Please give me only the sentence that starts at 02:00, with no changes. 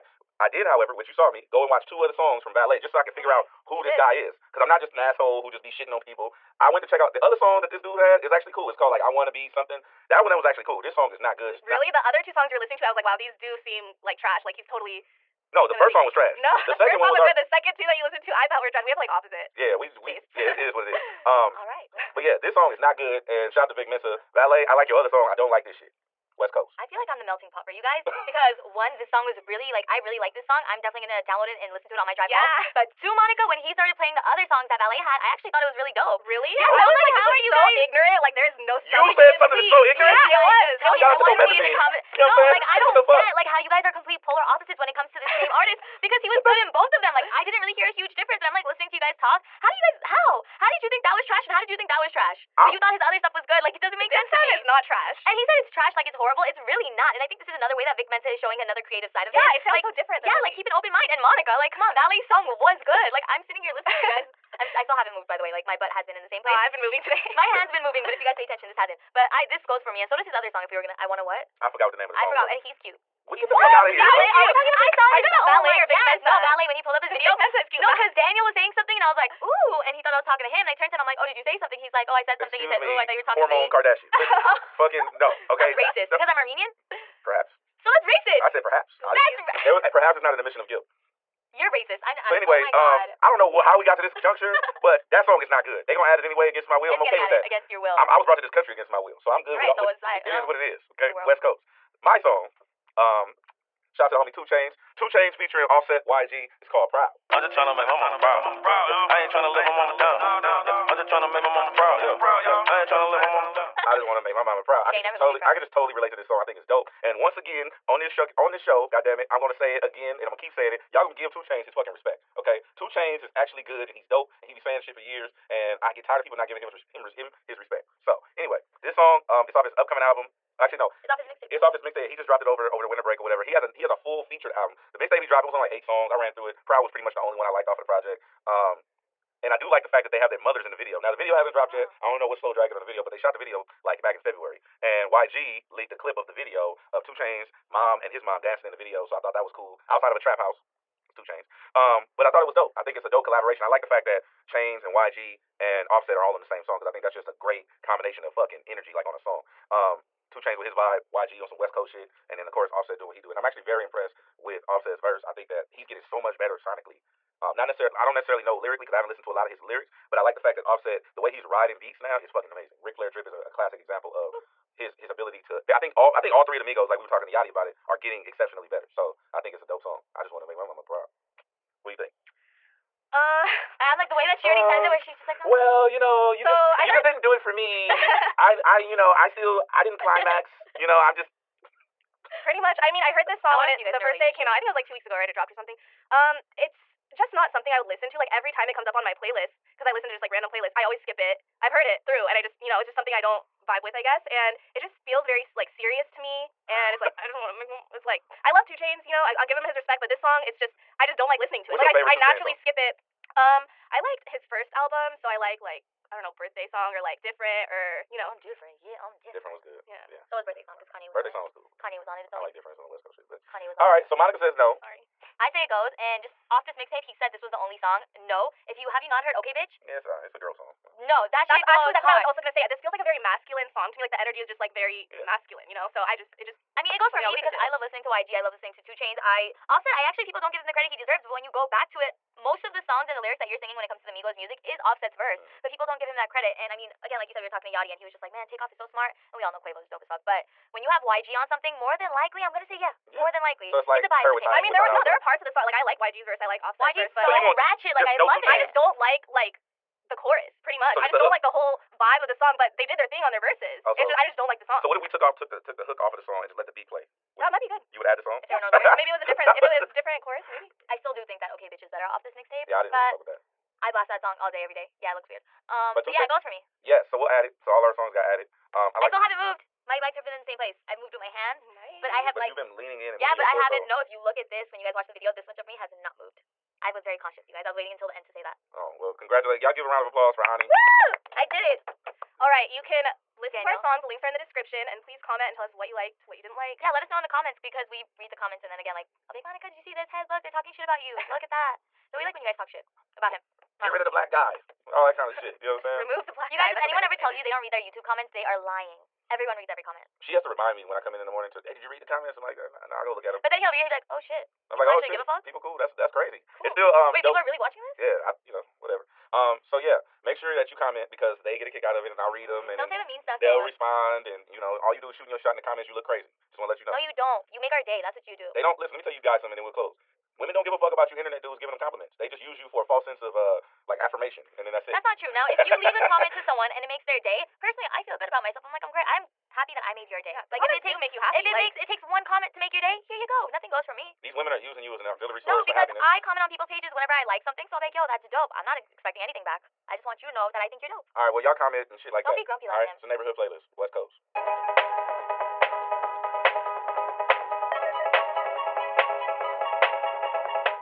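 Y'all gonna give 2 Chainz his fucking respect.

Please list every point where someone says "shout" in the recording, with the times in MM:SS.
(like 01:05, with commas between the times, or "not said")
00:23, 00:41, 01:43.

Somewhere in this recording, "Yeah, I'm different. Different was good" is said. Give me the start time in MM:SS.
03:38.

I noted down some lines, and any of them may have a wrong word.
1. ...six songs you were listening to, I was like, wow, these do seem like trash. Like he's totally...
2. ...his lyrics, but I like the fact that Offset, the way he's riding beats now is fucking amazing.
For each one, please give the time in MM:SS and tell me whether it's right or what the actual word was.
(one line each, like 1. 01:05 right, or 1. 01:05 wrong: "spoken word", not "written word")
1. 00:12 wrong: "two", not "six"
2. 02:49 right.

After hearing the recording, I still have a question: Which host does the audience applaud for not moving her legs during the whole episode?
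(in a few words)
Ani.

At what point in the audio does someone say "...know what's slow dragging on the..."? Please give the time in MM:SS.
02:22.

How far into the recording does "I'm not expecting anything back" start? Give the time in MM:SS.
05:48.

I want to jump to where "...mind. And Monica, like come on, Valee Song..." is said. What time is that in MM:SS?
01:00.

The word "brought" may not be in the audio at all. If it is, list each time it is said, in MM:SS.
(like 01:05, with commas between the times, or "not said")
01:38.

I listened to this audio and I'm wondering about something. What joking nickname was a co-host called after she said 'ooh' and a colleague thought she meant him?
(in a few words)
Hormone Kardashian.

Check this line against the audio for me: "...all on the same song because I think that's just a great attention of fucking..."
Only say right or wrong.
wrong.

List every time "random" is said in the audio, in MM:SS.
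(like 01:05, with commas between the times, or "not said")
03:20.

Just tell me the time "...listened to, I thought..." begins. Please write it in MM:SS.
00:18.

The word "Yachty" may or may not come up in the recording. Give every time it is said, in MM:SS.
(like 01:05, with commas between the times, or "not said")
02:57, 04:07.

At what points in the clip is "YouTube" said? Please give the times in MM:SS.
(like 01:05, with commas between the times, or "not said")
05:07.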